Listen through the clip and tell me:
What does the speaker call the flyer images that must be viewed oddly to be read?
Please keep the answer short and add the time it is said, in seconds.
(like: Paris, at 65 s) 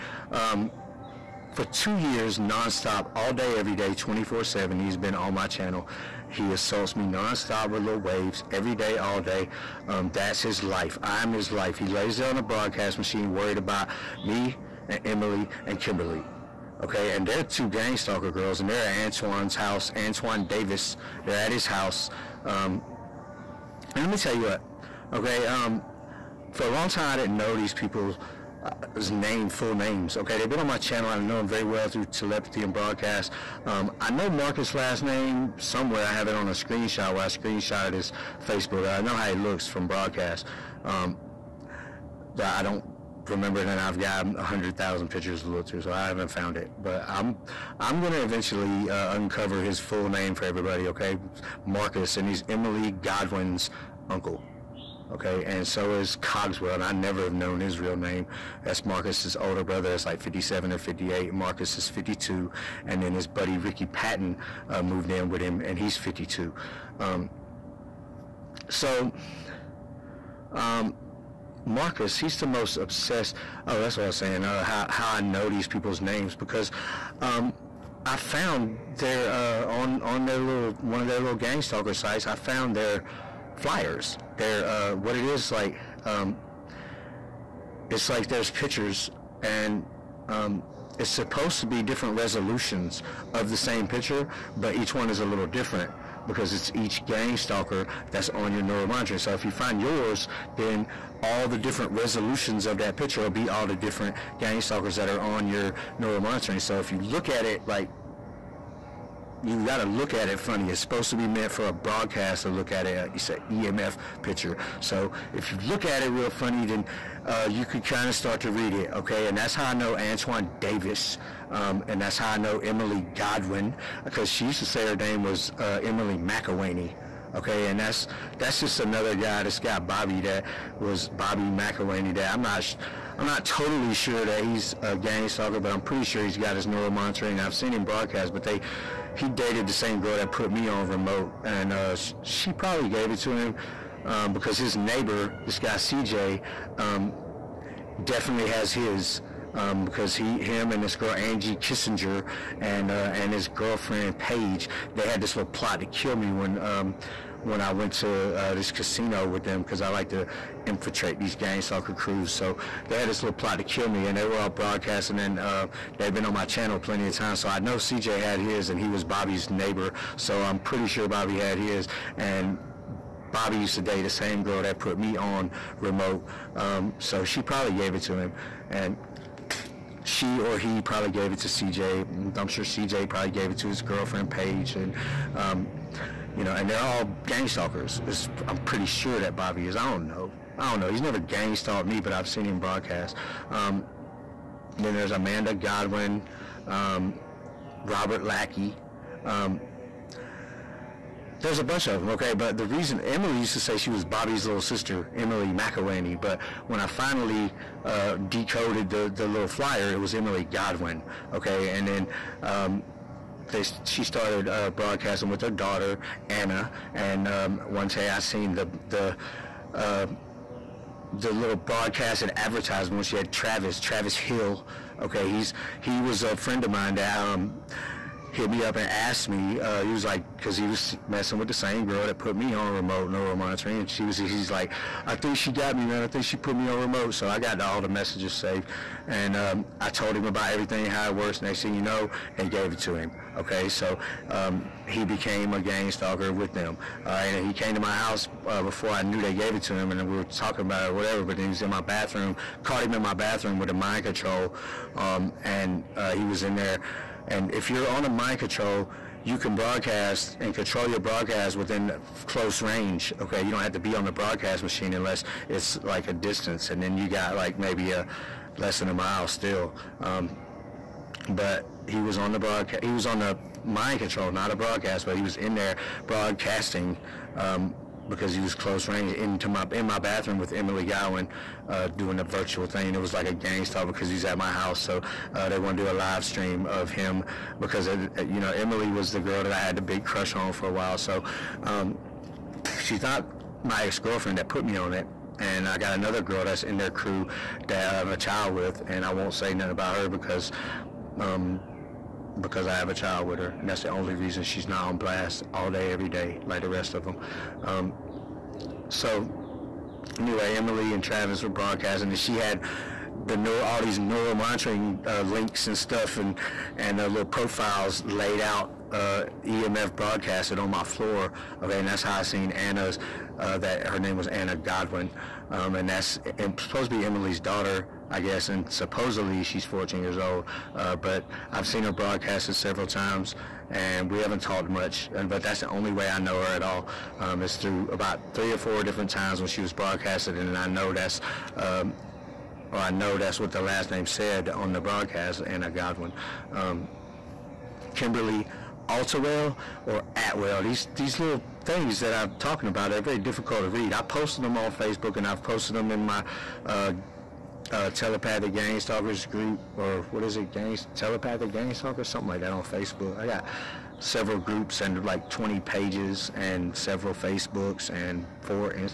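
EMF picture, at 113 s.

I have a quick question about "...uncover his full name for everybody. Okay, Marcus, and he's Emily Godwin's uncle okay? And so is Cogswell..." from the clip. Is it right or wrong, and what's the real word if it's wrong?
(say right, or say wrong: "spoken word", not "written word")
right.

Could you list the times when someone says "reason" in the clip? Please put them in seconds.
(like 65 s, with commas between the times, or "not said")
202 s, 304 s.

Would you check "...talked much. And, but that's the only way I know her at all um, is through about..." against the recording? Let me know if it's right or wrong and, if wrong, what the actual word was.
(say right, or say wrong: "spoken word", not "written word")
right.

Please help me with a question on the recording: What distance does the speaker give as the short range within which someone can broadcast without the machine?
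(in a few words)
less than a mile.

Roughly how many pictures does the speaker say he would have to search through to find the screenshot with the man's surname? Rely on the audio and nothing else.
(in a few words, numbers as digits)
100,000.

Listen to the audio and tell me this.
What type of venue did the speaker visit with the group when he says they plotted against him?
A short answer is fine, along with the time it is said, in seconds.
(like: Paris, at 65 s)
casino, at 158 s.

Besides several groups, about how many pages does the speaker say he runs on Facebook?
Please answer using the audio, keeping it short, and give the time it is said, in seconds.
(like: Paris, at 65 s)
20, at 365 s.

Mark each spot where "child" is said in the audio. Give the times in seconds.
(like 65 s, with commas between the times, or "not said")
298 s, 302 s.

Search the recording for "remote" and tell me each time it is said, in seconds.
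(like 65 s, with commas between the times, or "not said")
140 s, 175 s, 232 s, 236 s.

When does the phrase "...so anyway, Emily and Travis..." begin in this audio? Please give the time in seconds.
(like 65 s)
308 s.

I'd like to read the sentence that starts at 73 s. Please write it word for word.
Oh, that's what I was saying.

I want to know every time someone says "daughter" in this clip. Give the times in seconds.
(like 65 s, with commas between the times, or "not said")
215 s, 327 s.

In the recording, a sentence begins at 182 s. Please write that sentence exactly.
I'm sure CJ probably gave it to his girlfriend Paige, and um, you know, and they're all gang stalkers.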